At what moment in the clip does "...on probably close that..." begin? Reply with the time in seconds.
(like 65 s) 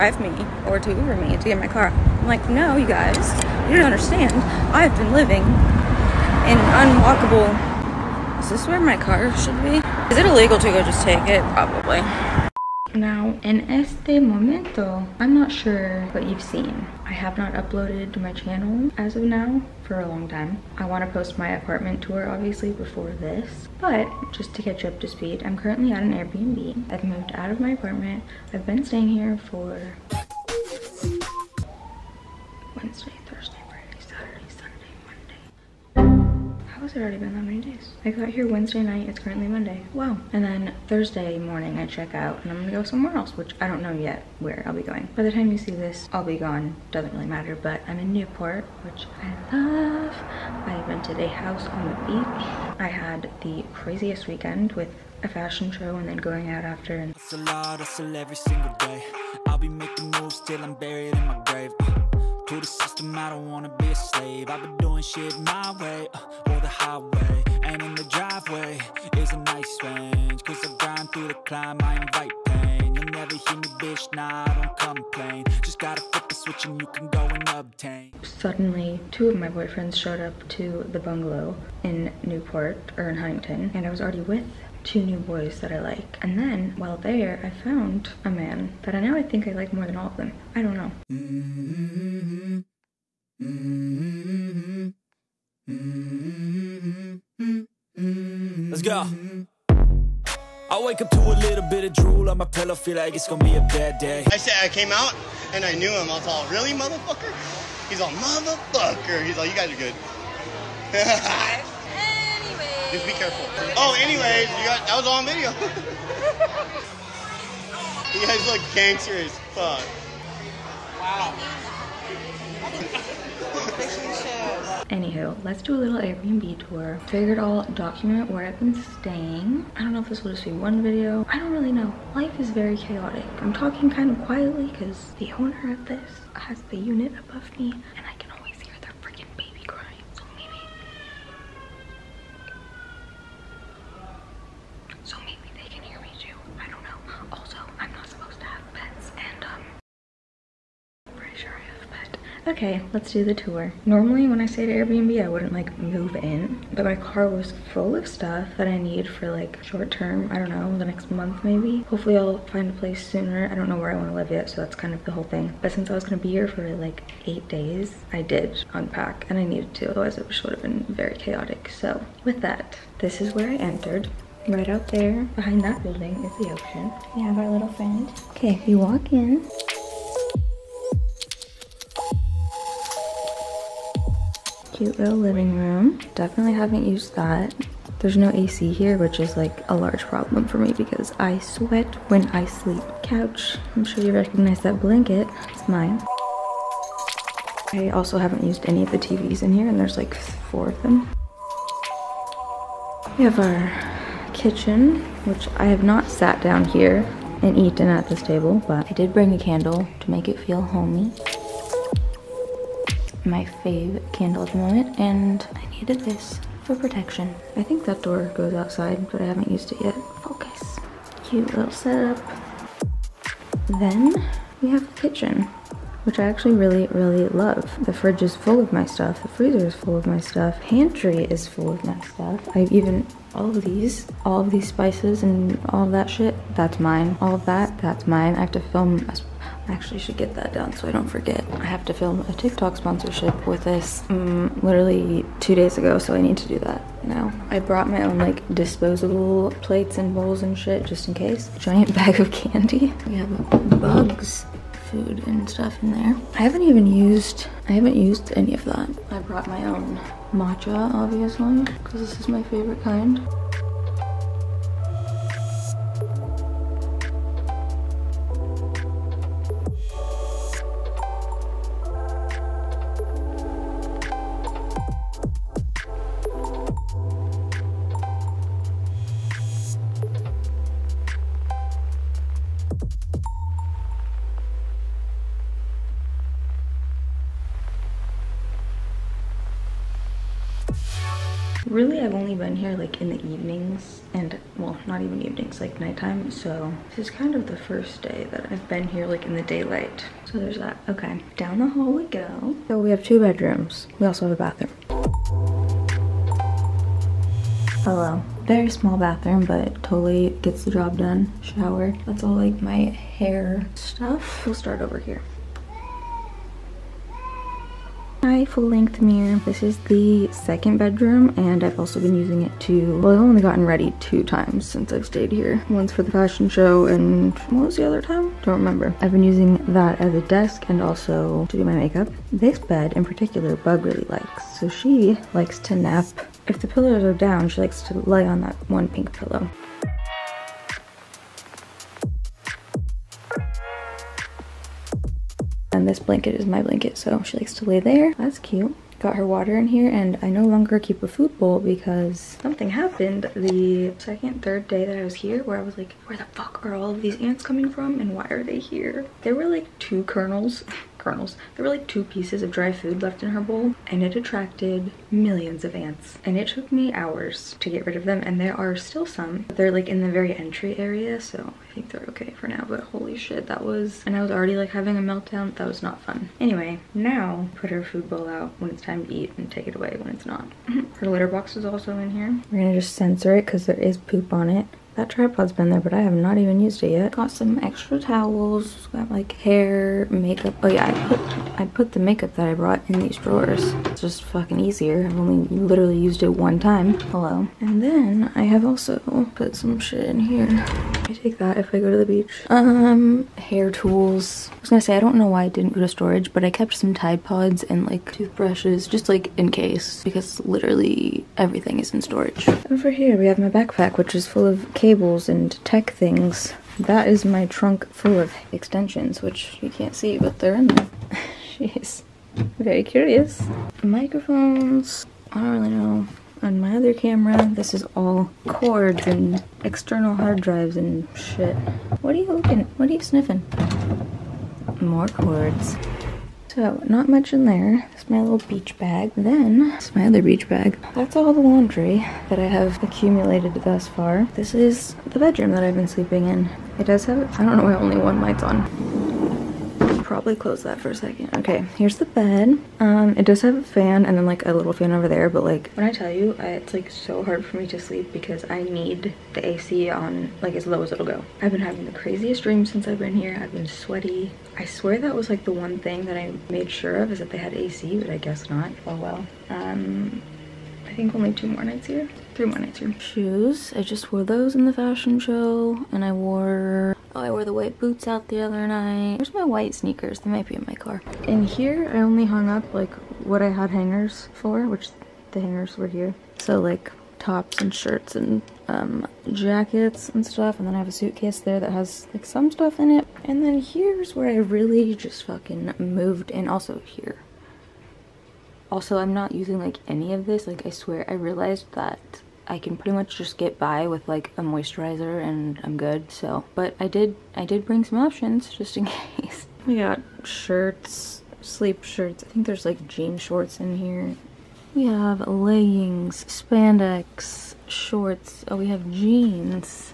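448 s.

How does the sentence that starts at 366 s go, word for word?
And it took me hours to get rid of them and there are still some, they're like in the very entry area.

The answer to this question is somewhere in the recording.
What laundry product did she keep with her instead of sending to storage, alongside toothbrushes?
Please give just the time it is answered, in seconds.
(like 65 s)
406 s.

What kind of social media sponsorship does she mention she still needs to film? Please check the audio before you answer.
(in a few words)
TikTok.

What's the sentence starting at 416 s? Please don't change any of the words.
That is my trunk full of extensions, which you can't see, but they're in there.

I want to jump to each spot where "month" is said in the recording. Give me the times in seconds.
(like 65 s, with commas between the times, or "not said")
161 s.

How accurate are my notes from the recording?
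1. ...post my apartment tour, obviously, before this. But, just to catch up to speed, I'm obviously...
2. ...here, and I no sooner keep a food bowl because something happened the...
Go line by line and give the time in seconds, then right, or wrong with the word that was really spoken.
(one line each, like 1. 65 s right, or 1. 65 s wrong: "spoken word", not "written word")
1. 21 s wrong: "currently", not "obviously"
2. 349 s wrong: "longer", not "sooner".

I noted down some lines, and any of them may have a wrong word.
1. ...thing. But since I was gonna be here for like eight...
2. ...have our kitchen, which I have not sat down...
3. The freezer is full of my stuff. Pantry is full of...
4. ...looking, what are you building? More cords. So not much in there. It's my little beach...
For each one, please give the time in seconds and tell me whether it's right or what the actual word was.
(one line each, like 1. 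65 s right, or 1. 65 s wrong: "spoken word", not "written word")
1. 165 s right
2. 203 s right
3. 229 s right
4. 432 s wrong: "sniffing", not "building".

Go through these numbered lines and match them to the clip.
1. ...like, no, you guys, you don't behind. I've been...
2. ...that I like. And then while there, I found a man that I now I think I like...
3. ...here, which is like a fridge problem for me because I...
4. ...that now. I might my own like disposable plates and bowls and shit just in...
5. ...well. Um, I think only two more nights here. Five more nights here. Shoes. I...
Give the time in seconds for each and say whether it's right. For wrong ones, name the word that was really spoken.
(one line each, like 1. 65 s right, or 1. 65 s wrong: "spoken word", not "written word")
1. 2 s wrong: "understand", not "behind"
2. 85 s right
3. 188 s wrong: "large", not "fridge"
4. 246 s wrong: "brought", not "might"
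5. 468 s wrong: "Three", not "Five".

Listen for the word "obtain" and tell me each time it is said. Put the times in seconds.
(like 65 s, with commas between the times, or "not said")
77 s.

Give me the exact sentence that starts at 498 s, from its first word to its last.
Also, I'm not using like any of this.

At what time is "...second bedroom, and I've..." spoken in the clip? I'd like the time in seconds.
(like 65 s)
320 s.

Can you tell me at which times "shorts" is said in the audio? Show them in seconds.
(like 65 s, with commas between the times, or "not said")
159 s, 513 s, 517 s.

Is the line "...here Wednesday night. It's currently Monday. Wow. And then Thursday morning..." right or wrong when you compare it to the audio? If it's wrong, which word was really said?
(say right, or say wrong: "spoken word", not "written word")
right.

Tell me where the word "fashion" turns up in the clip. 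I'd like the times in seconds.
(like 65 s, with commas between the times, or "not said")
55 s, 326 s, 474 s.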